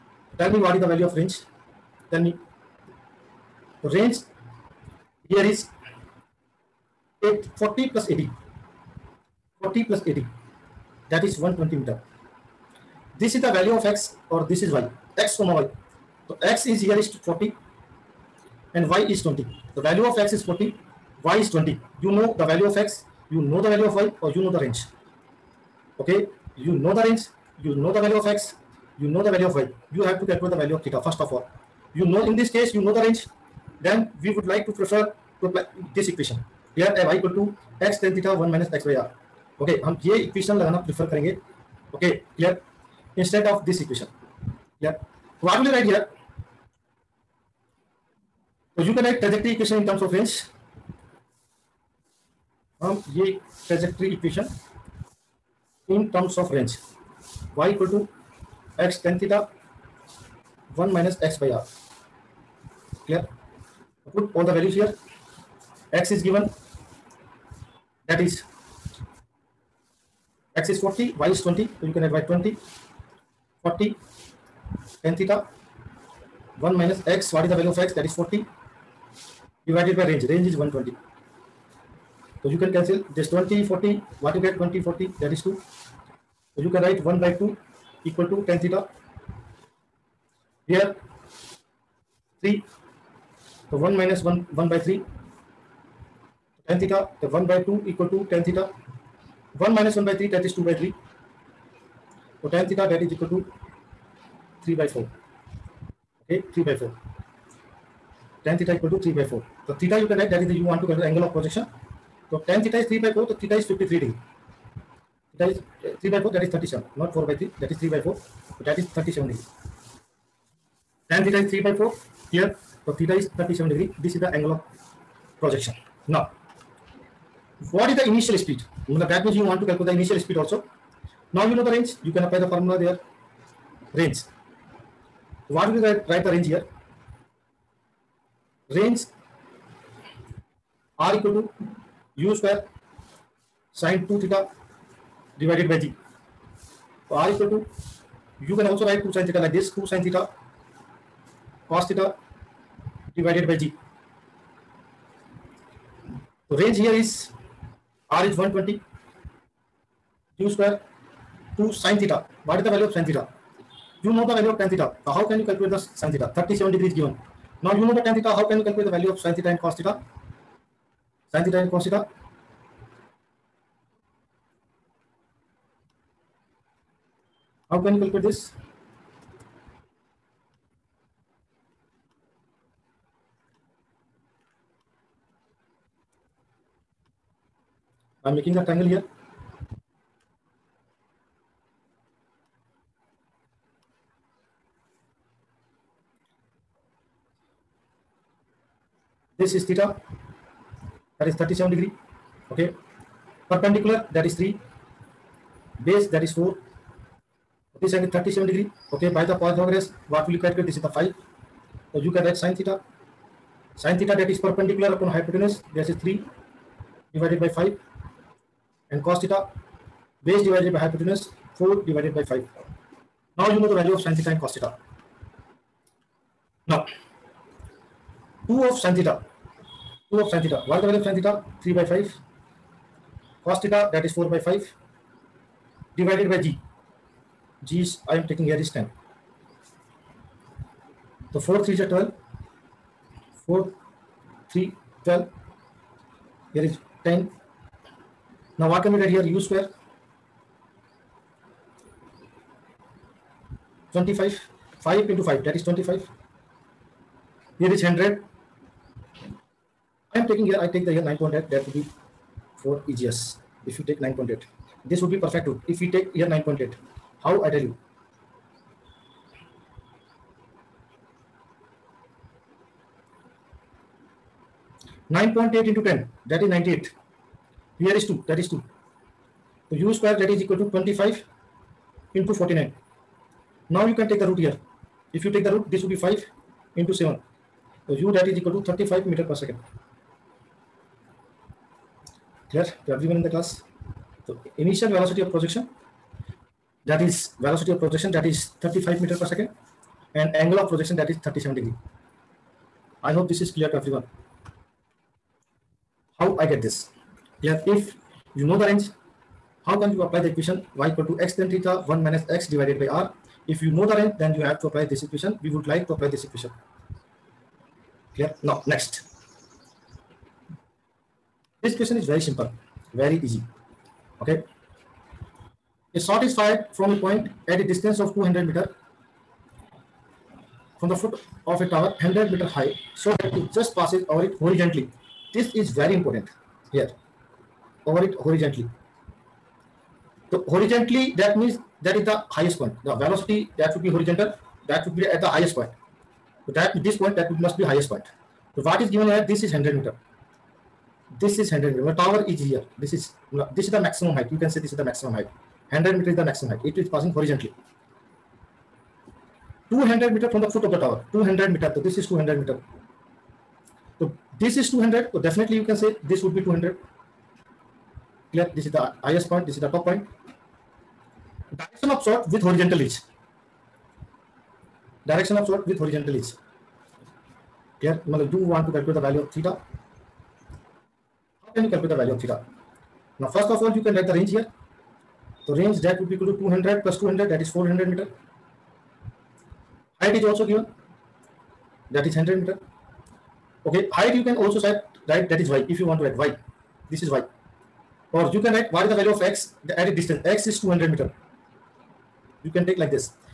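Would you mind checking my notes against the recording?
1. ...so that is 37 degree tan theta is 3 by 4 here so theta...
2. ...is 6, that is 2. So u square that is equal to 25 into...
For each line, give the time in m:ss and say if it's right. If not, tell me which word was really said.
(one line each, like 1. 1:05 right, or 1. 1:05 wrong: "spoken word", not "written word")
1. 1:58 right
2. 4:37 wrong: "2", not "6".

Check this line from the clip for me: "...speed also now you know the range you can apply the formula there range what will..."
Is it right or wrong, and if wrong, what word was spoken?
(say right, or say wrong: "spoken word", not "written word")
right.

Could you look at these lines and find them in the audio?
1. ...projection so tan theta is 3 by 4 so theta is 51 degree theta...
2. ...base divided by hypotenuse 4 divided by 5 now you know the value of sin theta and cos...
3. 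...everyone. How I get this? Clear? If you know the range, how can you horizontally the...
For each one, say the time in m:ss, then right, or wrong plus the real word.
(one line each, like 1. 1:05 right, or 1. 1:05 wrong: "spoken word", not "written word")
1. 1:51 wrong: "53", not "51"
2. 3:40 right
3. 5:03 wrong: "apply", not "horizontally".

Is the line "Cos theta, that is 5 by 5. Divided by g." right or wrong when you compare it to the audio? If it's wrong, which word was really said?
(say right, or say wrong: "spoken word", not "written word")
wrong: "4", not "5".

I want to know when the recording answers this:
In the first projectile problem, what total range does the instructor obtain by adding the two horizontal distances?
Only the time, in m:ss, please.
0:11.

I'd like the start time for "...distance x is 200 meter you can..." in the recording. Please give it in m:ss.
6:39.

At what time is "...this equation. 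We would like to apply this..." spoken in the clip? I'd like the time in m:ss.
5:14.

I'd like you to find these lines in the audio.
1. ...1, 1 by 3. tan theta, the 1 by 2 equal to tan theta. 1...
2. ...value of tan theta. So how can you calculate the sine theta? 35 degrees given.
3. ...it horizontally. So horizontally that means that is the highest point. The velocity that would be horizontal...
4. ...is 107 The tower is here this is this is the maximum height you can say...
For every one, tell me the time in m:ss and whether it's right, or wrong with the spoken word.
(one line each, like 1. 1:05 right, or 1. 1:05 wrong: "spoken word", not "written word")
1. 1:34 right
2. 2:44 wrong: "37", not "35"
3. 5:38 right
4. 5:51 wrong: "100", not "107".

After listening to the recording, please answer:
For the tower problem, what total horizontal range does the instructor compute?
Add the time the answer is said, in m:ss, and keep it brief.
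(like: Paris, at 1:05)
400 meters, at 6:27.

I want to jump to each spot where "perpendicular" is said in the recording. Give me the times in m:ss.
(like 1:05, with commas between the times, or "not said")
3:23, 3:34.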